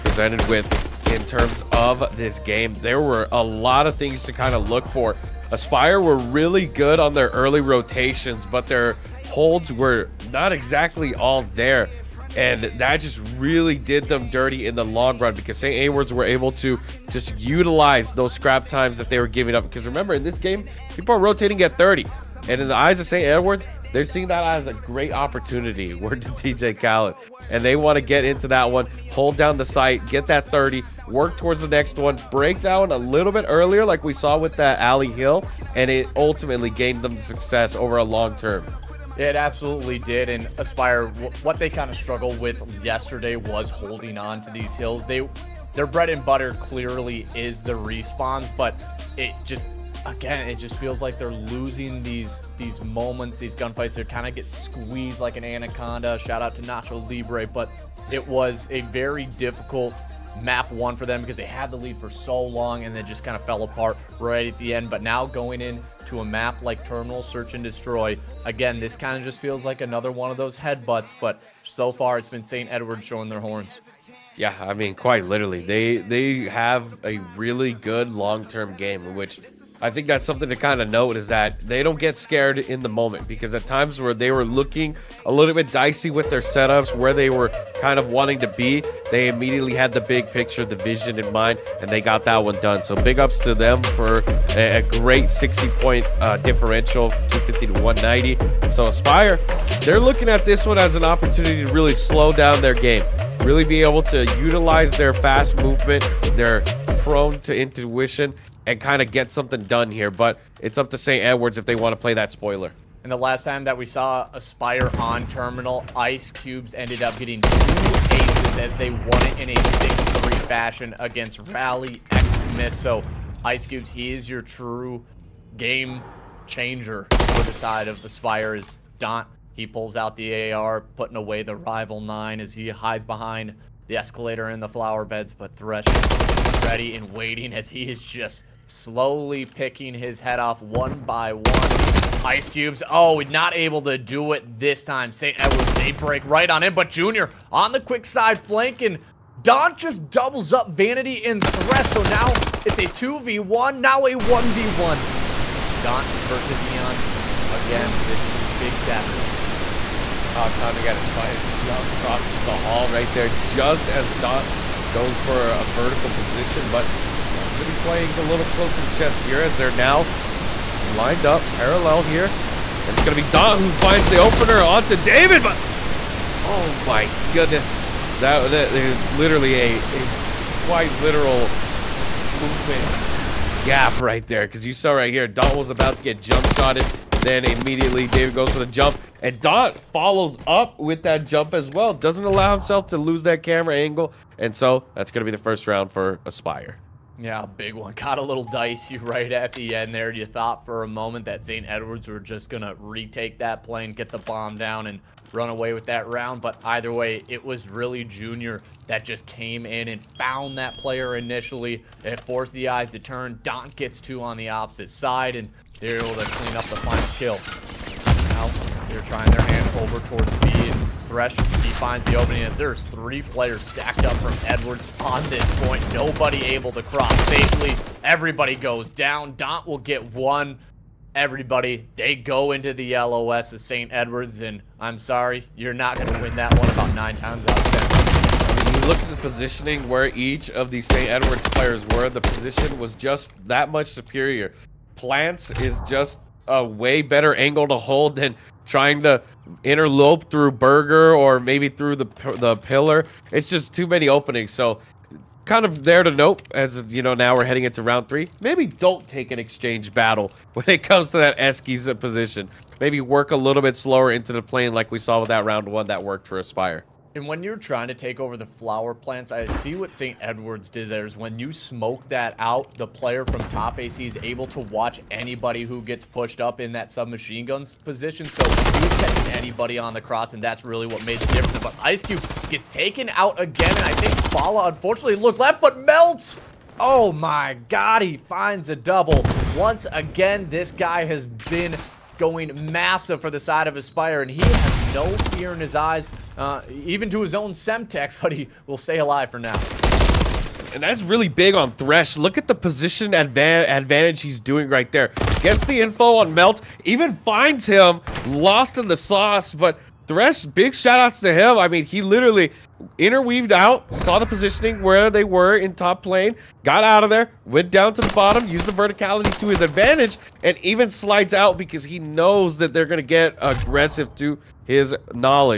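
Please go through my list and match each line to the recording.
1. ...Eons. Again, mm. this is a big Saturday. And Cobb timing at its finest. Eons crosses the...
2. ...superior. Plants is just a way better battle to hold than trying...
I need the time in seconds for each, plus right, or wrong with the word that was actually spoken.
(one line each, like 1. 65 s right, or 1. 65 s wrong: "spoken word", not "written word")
1. 156 s right
2. 243 s wrong: "angle", not "battle".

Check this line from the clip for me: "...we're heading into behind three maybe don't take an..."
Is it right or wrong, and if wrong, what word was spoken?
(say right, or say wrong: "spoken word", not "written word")
wrong: "round", not "behind".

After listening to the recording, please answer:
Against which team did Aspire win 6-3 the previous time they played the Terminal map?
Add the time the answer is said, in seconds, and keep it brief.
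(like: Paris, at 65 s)
Rally X Miss, at 121 s.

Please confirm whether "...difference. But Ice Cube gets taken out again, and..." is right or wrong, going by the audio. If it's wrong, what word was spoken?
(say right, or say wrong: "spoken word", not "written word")
right.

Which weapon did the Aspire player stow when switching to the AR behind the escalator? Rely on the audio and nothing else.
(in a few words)
Rival nine.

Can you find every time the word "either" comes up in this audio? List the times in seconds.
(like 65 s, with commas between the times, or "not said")
206 s.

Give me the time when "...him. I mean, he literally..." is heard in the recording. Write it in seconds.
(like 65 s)
311 s.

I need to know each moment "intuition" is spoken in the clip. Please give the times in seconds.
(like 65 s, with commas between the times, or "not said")
107 s.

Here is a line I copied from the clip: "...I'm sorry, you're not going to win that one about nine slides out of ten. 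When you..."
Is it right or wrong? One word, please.
wrong.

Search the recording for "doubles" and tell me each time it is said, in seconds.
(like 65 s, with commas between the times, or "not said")
150 s, 288 s.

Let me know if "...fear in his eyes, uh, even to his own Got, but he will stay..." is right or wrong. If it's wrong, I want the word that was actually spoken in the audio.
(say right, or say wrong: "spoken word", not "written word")
wrong: "Semtex", not "Got".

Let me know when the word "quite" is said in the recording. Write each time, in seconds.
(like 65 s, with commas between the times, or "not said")
74 s, 180 s.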